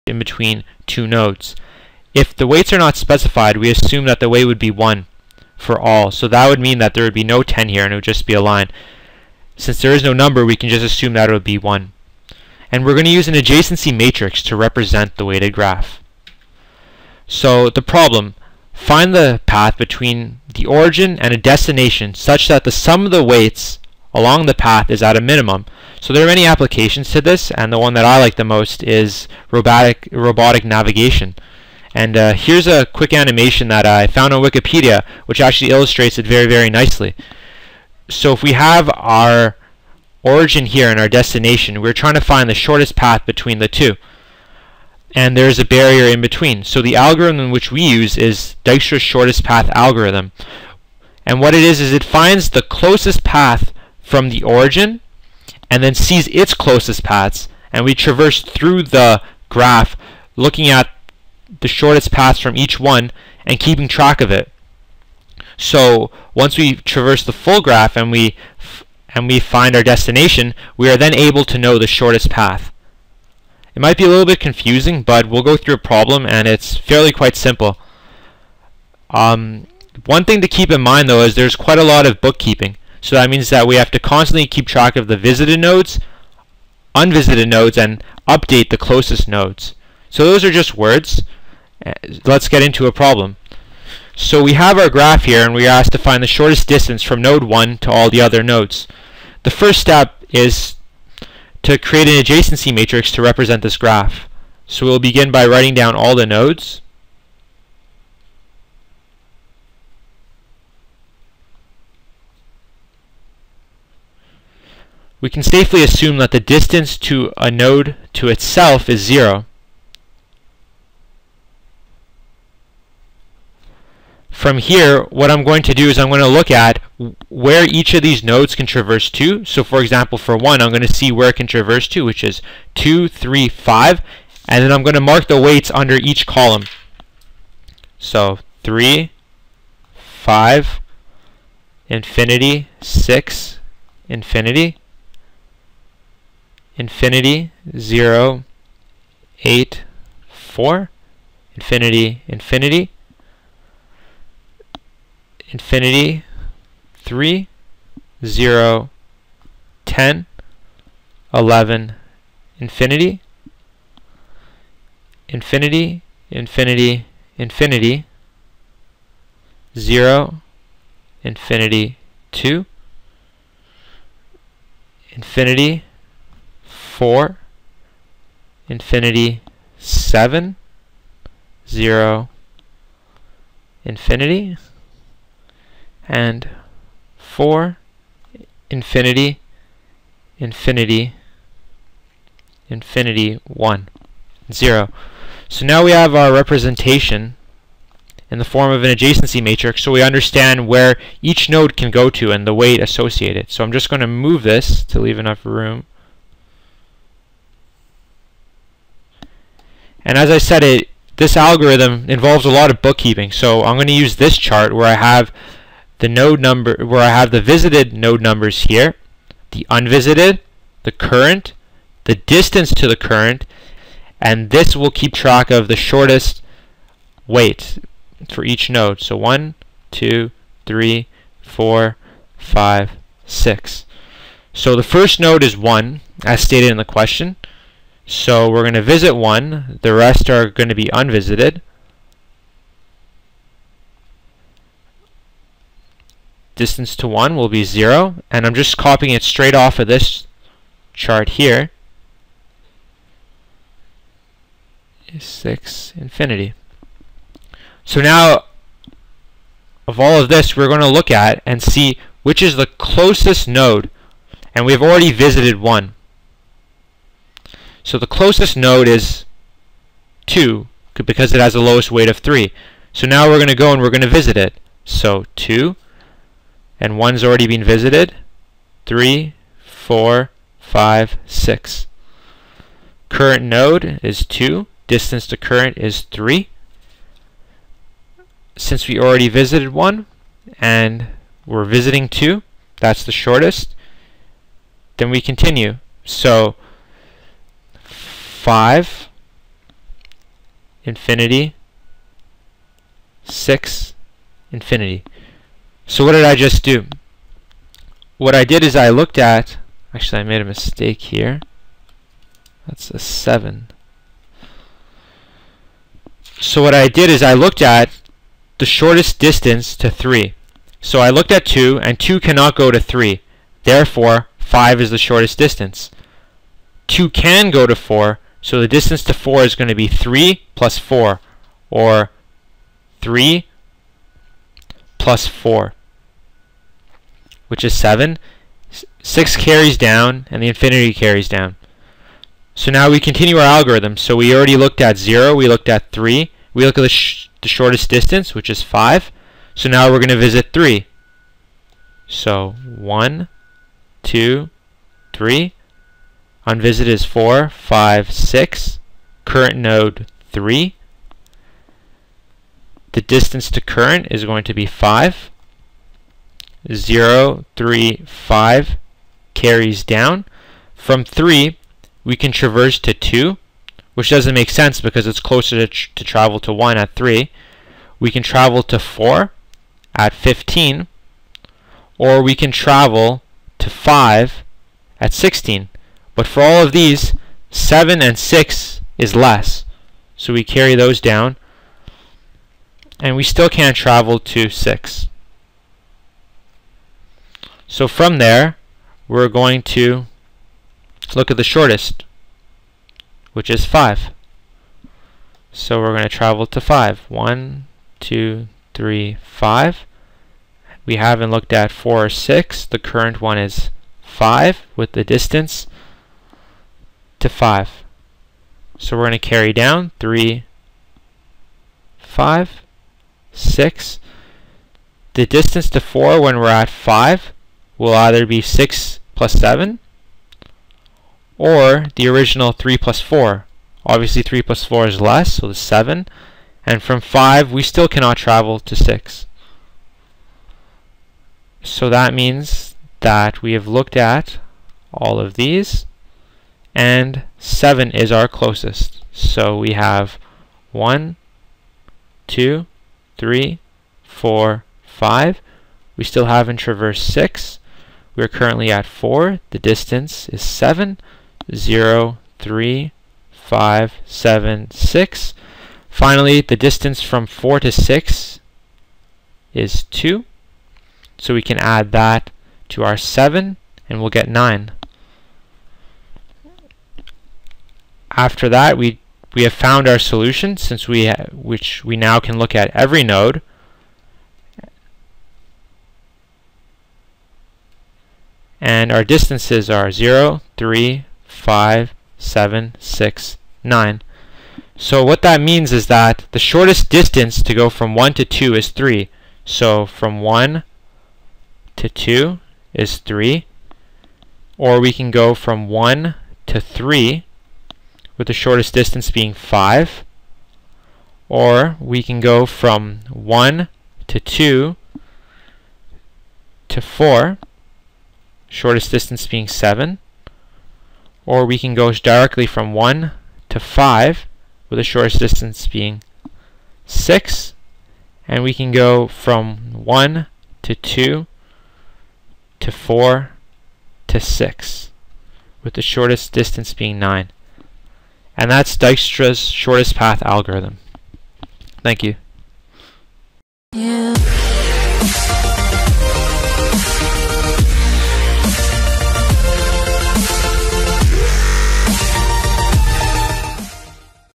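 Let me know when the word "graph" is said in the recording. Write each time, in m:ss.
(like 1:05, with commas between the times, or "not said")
0:15, 0:59, 1:07, 1:34, 1:43.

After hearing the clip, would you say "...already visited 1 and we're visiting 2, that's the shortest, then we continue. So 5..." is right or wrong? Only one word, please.
right.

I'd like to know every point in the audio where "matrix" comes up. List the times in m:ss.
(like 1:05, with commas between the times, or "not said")
0:13, 1:42, 3:19.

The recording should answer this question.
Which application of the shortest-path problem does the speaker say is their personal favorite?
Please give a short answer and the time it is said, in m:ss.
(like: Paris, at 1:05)
Robotic navigation, at 0:30.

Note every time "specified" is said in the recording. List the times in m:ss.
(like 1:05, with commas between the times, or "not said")
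0:02.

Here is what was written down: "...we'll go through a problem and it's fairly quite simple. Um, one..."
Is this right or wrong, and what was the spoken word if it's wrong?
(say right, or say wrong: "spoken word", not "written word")
right.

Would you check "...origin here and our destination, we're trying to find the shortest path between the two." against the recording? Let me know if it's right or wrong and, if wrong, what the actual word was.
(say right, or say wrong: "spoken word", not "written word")
right.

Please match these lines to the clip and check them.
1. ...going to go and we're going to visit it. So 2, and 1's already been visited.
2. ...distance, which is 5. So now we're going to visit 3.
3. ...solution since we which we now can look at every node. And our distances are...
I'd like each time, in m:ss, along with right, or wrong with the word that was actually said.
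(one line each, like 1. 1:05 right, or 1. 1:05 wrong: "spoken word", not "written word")
1. 4:33 right
2. 5:47 right
3. 7:59 right.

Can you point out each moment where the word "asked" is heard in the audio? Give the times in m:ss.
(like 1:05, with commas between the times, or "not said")
1:35.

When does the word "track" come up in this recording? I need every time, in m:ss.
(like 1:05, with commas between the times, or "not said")
1:03, 1:24, 3:45.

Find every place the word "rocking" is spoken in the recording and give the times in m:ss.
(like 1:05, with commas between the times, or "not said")
not said.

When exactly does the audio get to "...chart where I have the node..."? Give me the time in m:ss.
3:34.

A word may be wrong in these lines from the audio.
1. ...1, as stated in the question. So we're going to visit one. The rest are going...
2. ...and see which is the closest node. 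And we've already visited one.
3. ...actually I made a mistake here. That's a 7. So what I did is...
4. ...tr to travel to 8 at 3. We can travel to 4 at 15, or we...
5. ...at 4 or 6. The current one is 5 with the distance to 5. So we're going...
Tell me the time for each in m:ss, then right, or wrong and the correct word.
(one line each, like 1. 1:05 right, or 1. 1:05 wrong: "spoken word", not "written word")
1. 3:55 right
2. 4:21 right
3. 5:09 right
4. 6:15 wrong: "1", not "8"
5. 6:51 right.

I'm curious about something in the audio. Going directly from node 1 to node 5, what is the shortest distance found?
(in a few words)
6.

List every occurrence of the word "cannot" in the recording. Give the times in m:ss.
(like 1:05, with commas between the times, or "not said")
5:22, 7:17.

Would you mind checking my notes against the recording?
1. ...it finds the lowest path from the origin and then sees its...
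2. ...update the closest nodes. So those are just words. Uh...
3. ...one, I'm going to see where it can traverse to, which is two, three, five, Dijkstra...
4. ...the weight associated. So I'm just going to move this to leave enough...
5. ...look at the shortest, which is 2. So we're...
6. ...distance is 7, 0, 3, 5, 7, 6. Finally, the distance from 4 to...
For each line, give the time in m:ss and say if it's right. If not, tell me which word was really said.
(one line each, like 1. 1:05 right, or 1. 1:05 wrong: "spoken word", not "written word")
1. 0:51 wrong: "closest", not "lowest"
2. 1:28 right
3. 2:10 wrong: "And", not "Dijkstra"
4. 3:22 right
5. 6:41 wrong: "5", not "2"
6. 7:39 right.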